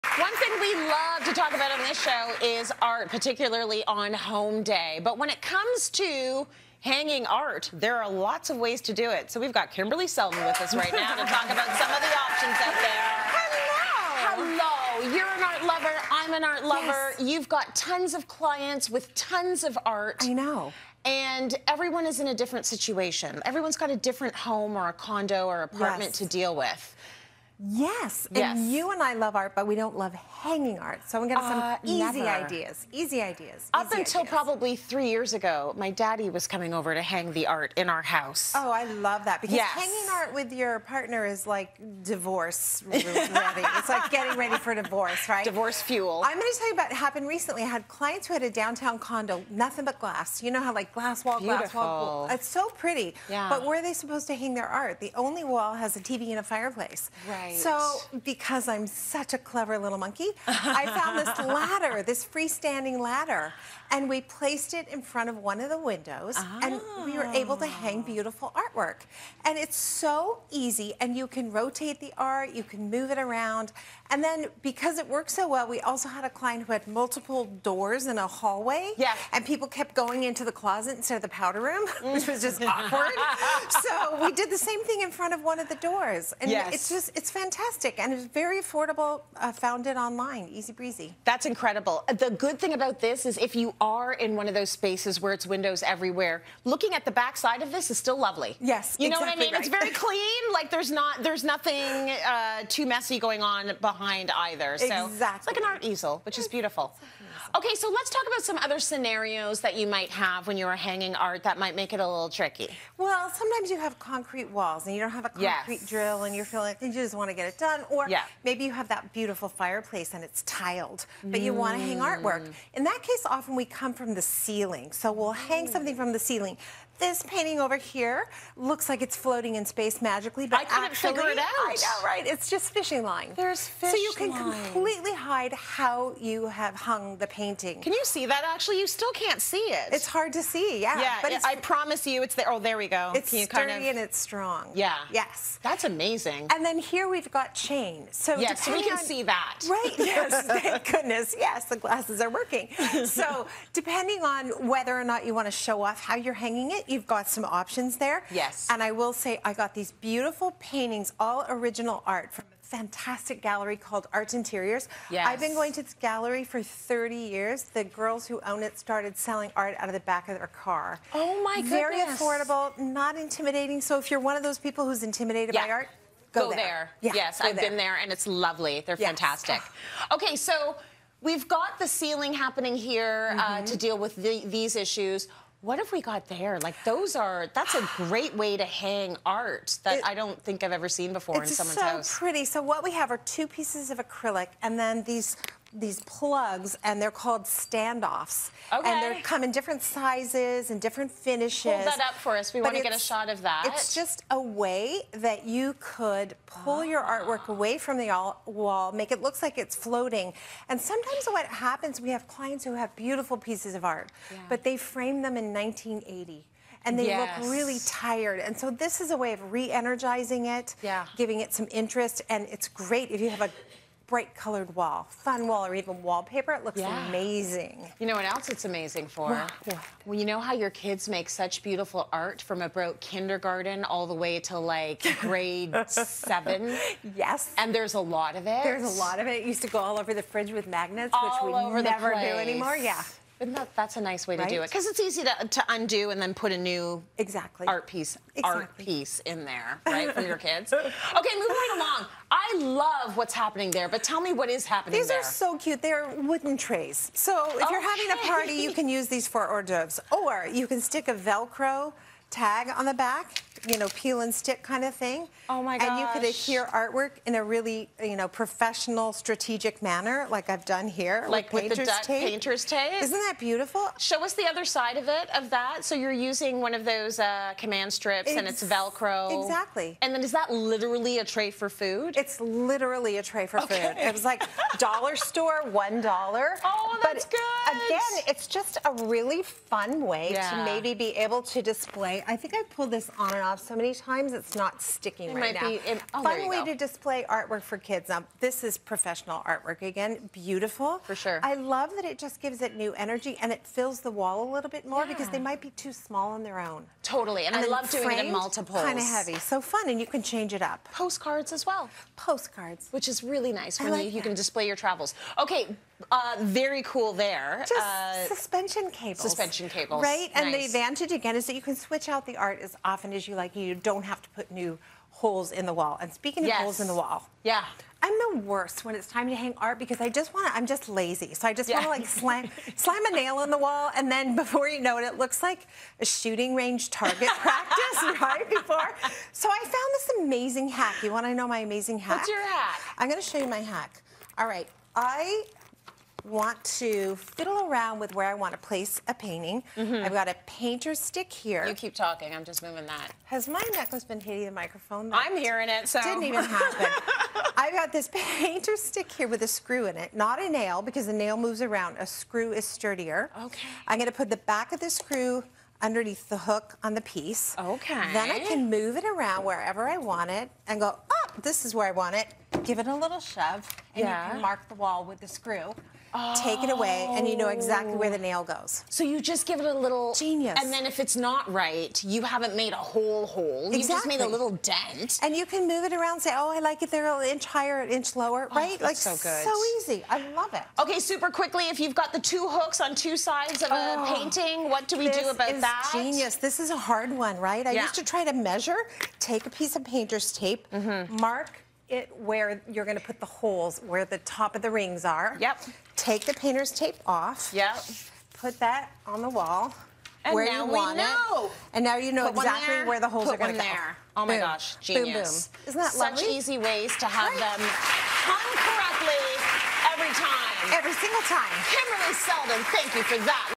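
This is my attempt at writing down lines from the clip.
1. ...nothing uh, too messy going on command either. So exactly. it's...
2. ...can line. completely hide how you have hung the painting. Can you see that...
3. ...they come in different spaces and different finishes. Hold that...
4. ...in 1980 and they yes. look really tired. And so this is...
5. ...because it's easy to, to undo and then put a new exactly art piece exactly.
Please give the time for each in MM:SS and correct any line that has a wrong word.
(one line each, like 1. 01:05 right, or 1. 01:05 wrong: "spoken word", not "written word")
1. 01:41 wrong: "behind", not "command"
2. 02:14 right
3. 03:19 wrong: "sizes", not "spaces"
4. 03:35 right
5. 04:04 right.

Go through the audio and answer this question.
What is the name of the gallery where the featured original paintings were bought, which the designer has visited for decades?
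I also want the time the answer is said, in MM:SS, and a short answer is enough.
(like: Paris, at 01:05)
Art Interiors, at 02:44.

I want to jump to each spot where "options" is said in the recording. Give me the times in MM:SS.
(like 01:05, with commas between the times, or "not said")
00:12, 02:37.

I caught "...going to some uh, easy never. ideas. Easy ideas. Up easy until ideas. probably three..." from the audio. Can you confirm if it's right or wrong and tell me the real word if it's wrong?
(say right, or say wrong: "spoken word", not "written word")
right.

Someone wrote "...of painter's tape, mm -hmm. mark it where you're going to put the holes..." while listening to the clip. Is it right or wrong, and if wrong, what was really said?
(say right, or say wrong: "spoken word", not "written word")
right.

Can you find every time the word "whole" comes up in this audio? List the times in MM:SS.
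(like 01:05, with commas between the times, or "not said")
06:22.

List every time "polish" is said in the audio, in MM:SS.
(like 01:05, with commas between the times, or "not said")
not said.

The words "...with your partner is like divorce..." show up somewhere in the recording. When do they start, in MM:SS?
00:40.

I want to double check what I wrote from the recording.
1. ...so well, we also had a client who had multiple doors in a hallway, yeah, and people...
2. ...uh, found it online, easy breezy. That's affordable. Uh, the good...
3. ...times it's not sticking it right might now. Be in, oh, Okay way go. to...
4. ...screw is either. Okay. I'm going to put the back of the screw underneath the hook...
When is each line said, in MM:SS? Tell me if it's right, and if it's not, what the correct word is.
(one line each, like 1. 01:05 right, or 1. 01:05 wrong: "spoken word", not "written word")
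1. 01:15 right
2. 01:29 wrong: "incredible", not "affordable"
3. 04:53 wrong: "Fun", not "Okay"
4. 06:02 wrong: "sturdier", not "either".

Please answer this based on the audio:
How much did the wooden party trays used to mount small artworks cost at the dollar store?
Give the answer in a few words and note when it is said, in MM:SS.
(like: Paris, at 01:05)
one dollar, at 04:45.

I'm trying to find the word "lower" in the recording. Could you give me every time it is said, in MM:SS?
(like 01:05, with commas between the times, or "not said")
06:28.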